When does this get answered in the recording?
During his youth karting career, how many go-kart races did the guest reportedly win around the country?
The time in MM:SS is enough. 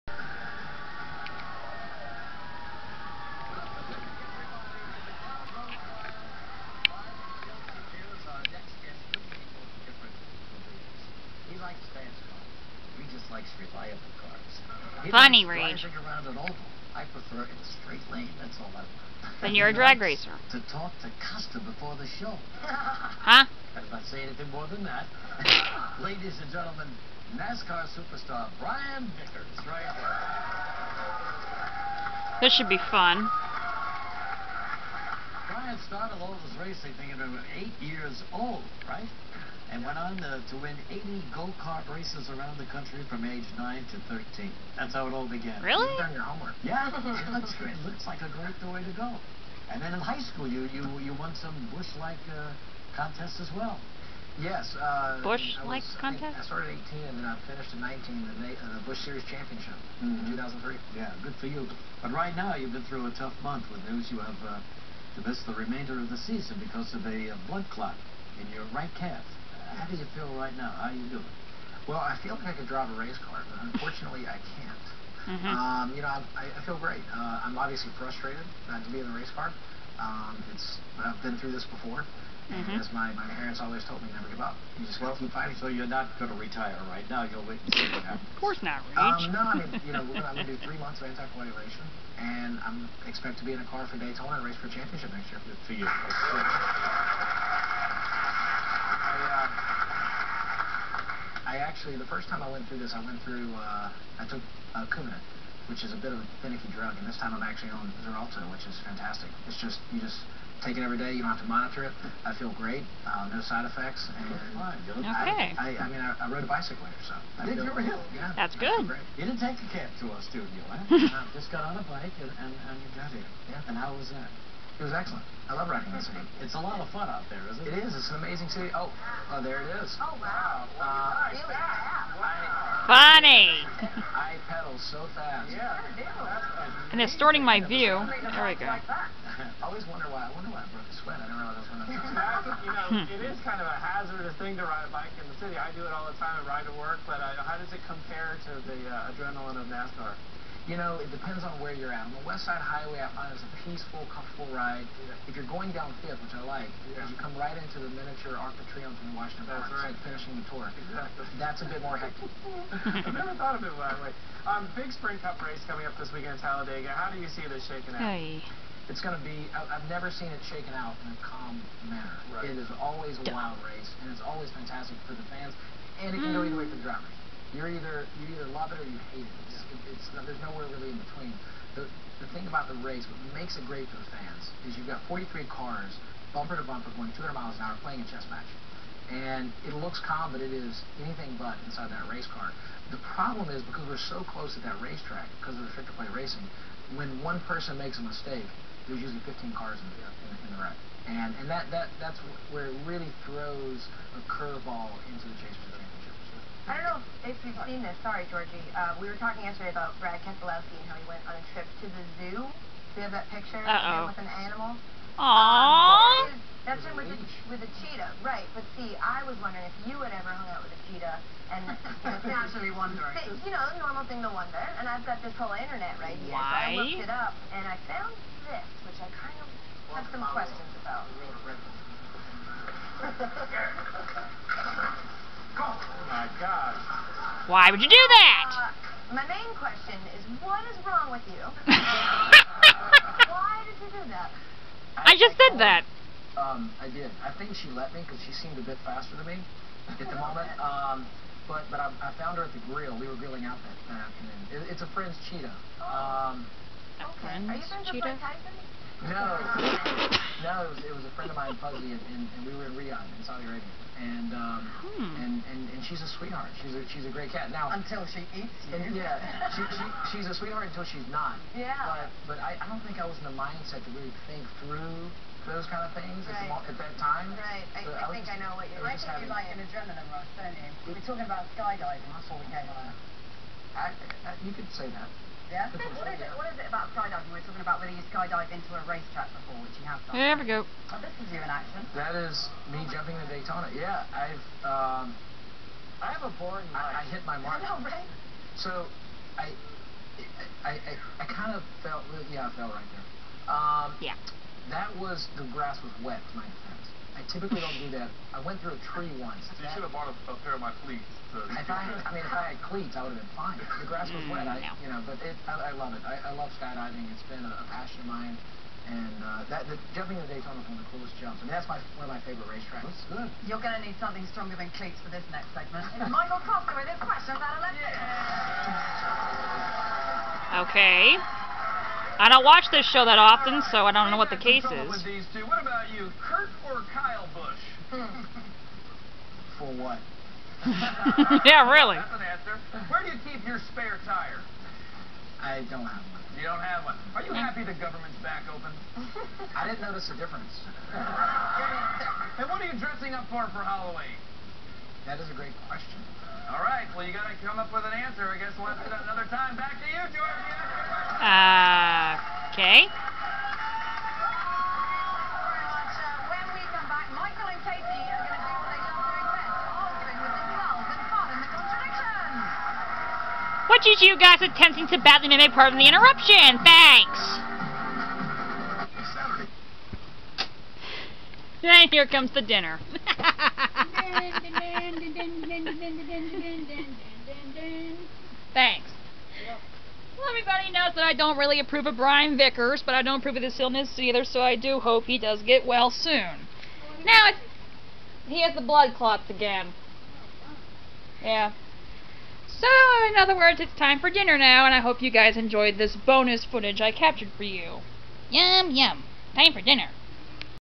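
00:40.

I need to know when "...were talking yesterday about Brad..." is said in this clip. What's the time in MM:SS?
03:29.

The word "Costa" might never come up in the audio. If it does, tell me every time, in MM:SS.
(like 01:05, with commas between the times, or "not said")
00:21, 05:26.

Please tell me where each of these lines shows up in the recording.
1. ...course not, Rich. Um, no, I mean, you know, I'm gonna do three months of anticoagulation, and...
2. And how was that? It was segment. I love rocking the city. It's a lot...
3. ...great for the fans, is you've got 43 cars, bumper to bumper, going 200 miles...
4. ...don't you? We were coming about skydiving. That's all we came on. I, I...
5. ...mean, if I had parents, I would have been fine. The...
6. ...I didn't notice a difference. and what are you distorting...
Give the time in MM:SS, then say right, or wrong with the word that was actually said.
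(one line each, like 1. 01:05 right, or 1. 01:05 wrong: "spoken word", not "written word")
1. 01:28 right
2. 02:03 wrong: "excellent", not "segment"
3. 03:03 right
4. 04:40 wrong: "talking", not "coming"
5. 05:12 wrong: "cleats", not "parents"
6. 05:49 wrong: "dressing", not "distorting".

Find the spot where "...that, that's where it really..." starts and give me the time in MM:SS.
03:21.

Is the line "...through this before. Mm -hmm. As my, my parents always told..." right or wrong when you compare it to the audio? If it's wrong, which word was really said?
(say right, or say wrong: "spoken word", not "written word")
right.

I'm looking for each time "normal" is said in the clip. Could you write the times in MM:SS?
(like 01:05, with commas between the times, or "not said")
03:43.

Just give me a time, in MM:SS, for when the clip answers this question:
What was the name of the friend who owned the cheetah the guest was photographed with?
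04:21.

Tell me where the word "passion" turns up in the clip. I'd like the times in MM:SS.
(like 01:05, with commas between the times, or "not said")
05:17.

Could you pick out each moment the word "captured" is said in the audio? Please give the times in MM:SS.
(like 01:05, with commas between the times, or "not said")
06:46.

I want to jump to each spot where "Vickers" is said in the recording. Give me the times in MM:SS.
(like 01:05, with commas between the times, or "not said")
00:29, 06:32.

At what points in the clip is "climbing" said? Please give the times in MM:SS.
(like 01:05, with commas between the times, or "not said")
not said.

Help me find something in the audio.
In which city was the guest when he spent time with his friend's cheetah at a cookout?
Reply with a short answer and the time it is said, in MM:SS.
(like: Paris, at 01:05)
Riyadh, at 04:22.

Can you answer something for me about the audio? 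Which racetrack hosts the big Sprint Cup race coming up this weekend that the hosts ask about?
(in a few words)
Talladega.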